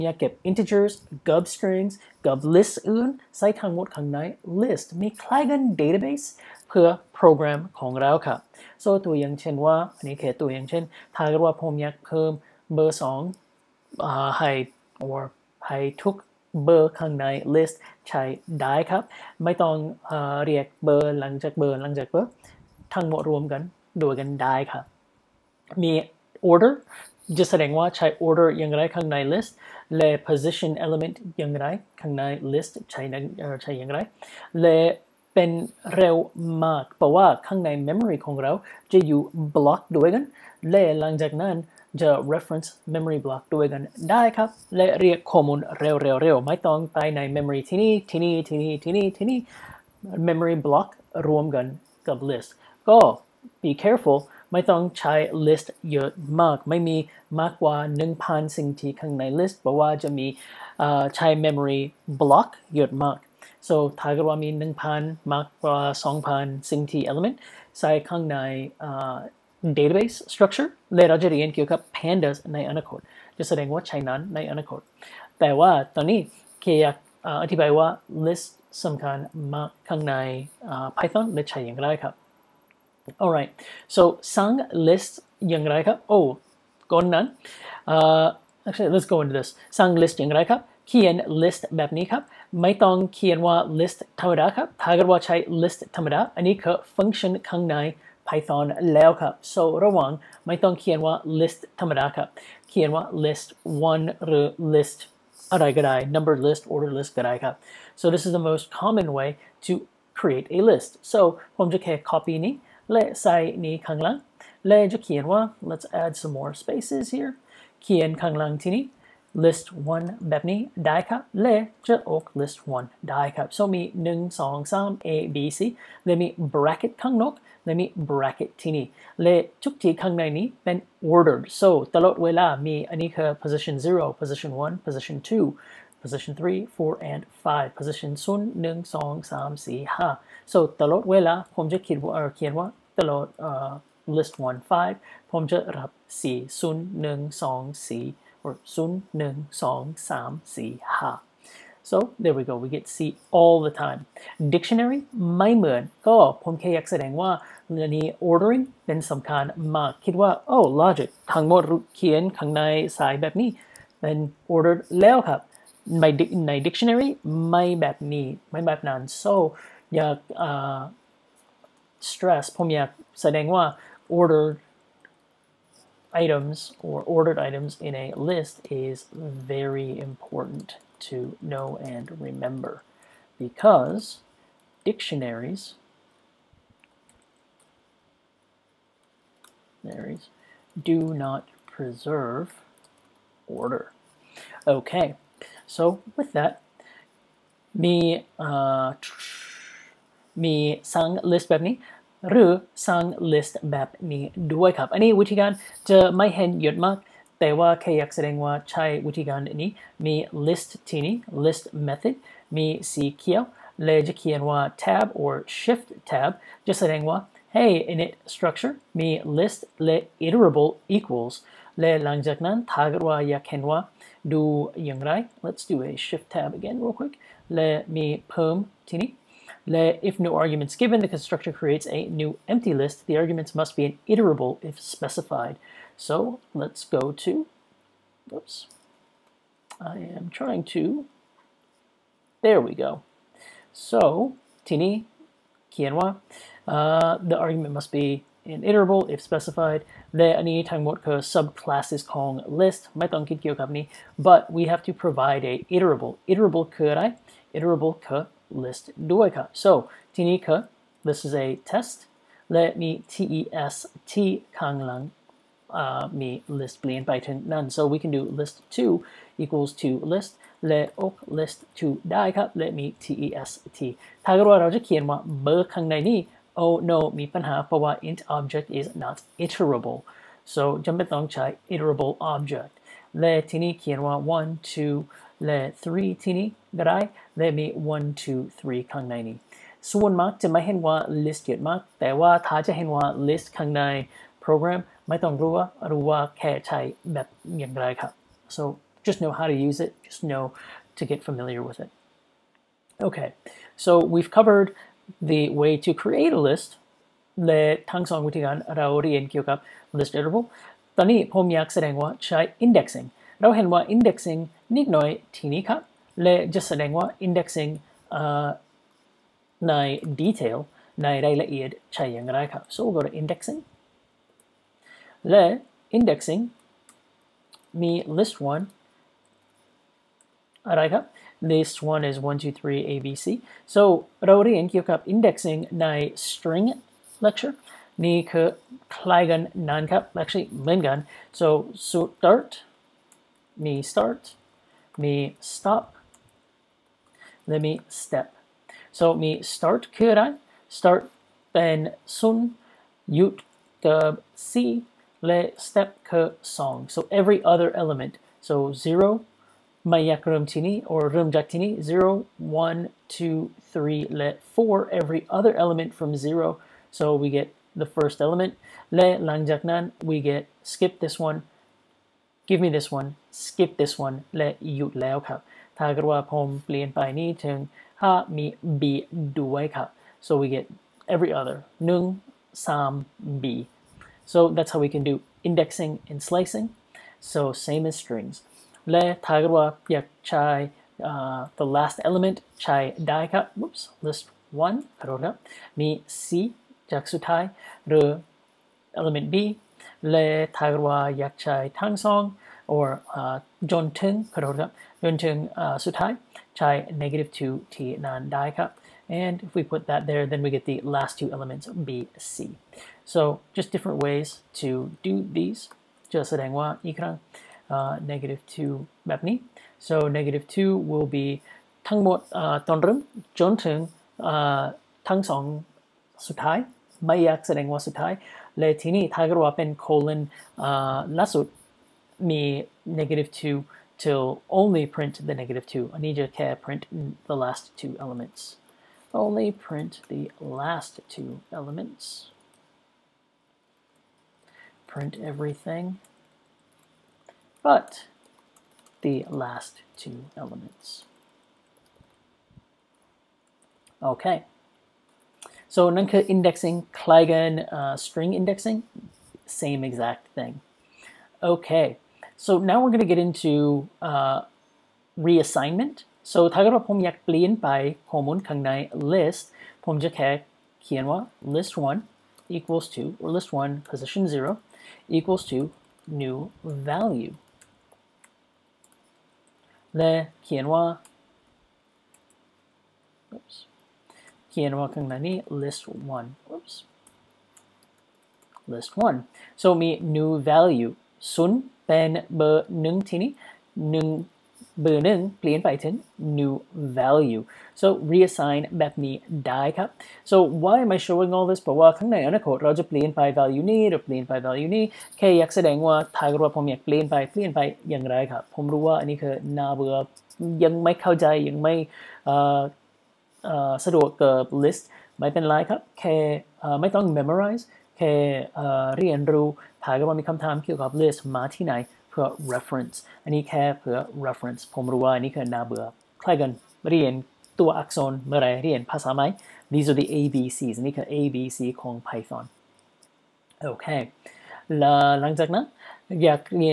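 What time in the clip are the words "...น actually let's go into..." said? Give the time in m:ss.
1:27.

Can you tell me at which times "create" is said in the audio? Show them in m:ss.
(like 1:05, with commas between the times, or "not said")
1:50, 3:51, 5:06.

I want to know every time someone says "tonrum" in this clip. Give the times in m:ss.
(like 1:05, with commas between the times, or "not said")
7:02.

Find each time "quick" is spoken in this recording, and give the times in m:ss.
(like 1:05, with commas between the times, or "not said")
3:46.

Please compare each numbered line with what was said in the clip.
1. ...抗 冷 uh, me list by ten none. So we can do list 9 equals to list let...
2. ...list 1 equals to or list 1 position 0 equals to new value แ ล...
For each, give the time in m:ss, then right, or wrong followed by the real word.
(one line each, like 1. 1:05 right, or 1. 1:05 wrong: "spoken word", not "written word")
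1. 4:24 wrong: "2", not "9"
2. 7:51 right.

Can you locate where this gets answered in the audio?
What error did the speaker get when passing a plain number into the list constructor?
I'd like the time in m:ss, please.
4:38.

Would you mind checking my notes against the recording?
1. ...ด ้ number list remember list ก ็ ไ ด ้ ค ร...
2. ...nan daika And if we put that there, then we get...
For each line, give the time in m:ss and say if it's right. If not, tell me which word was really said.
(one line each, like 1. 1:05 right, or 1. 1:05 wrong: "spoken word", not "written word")
1. 1:45 wrong: "order", not "remember"
2. 6:47 right.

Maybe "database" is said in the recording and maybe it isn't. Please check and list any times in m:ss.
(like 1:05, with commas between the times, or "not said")
0:05, 1:09.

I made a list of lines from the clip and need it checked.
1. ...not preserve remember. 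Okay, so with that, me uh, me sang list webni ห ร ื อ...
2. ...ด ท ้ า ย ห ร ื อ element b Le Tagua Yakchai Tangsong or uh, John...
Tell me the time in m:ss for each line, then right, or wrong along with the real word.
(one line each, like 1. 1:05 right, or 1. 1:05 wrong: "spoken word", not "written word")
1. 3:11 wrong: "order", not "remember"
2. 6:37 right.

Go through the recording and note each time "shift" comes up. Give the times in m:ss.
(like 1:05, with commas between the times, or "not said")
3:35, 3:46.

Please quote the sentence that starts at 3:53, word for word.
The arguments must be an iterable if specified.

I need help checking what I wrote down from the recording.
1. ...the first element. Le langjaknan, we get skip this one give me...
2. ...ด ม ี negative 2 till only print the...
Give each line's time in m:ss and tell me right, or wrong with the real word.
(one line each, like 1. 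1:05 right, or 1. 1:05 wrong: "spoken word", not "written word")
1. 6:07 right
2. 7:11 right.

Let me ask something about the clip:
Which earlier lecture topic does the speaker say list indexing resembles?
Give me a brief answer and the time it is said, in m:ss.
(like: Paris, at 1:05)
string lecture, at 5:36.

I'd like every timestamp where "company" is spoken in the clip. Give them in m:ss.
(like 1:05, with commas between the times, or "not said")
4:13.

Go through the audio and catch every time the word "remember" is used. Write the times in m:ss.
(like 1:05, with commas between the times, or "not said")
3:02.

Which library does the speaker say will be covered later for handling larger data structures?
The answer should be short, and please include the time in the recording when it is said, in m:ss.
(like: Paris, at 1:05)
pandas, at 1:11.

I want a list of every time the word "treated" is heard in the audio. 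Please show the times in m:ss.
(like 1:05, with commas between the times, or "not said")
not said.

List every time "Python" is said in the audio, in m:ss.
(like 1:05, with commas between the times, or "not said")
1:20, 1:38, 8:52.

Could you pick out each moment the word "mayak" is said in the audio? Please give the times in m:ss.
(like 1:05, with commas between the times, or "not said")
5:59, 7:07.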